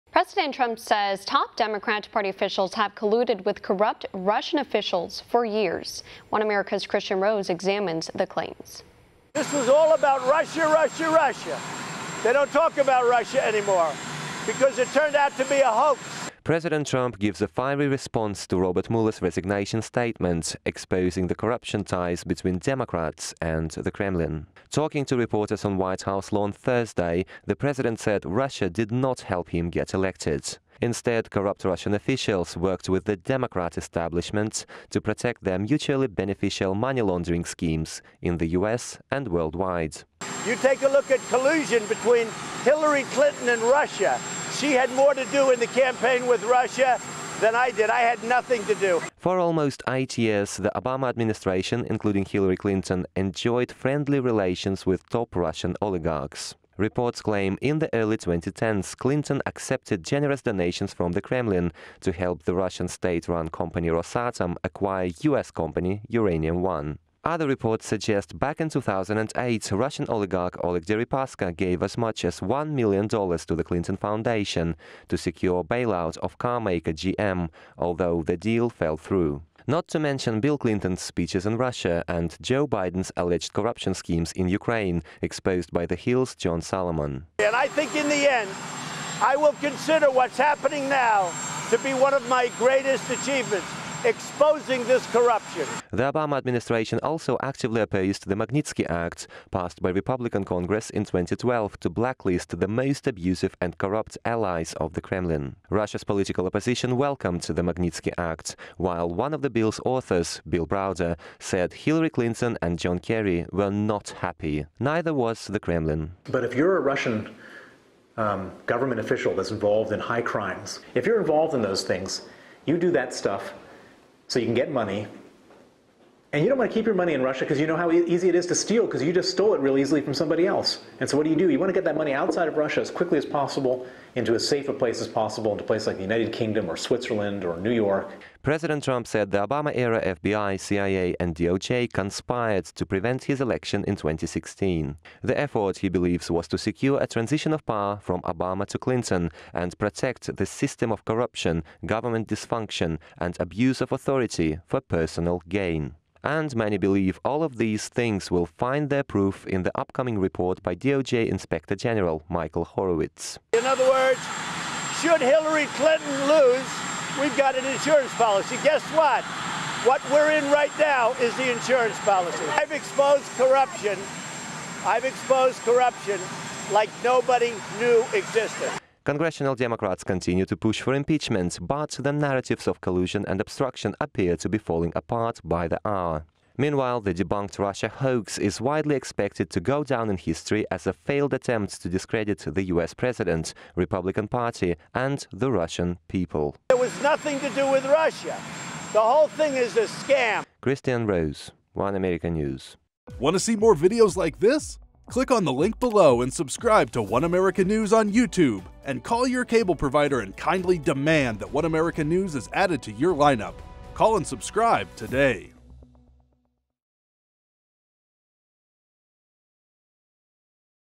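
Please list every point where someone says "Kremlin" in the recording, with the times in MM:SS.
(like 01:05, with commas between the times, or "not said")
00:23, 01:01, 01:45, 01:55.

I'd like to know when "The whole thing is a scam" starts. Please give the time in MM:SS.
03:18.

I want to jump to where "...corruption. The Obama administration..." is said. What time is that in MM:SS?
01:35.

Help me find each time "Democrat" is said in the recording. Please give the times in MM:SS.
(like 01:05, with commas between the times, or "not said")
00:01, 00:22, 00:33, 02:59.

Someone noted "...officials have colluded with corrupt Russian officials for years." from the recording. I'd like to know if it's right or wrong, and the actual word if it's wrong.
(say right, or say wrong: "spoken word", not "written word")
right.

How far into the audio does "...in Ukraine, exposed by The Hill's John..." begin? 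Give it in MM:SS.
01:24.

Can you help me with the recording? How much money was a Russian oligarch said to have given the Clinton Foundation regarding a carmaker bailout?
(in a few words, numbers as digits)
$1 million.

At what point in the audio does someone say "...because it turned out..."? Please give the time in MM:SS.
00:14.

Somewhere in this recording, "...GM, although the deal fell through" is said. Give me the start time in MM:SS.
01:16.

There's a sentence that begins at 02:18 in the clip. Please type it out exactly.
President Trump said the Obama era FBI, CIA, and DOJ conspired to prevent his election in 2016.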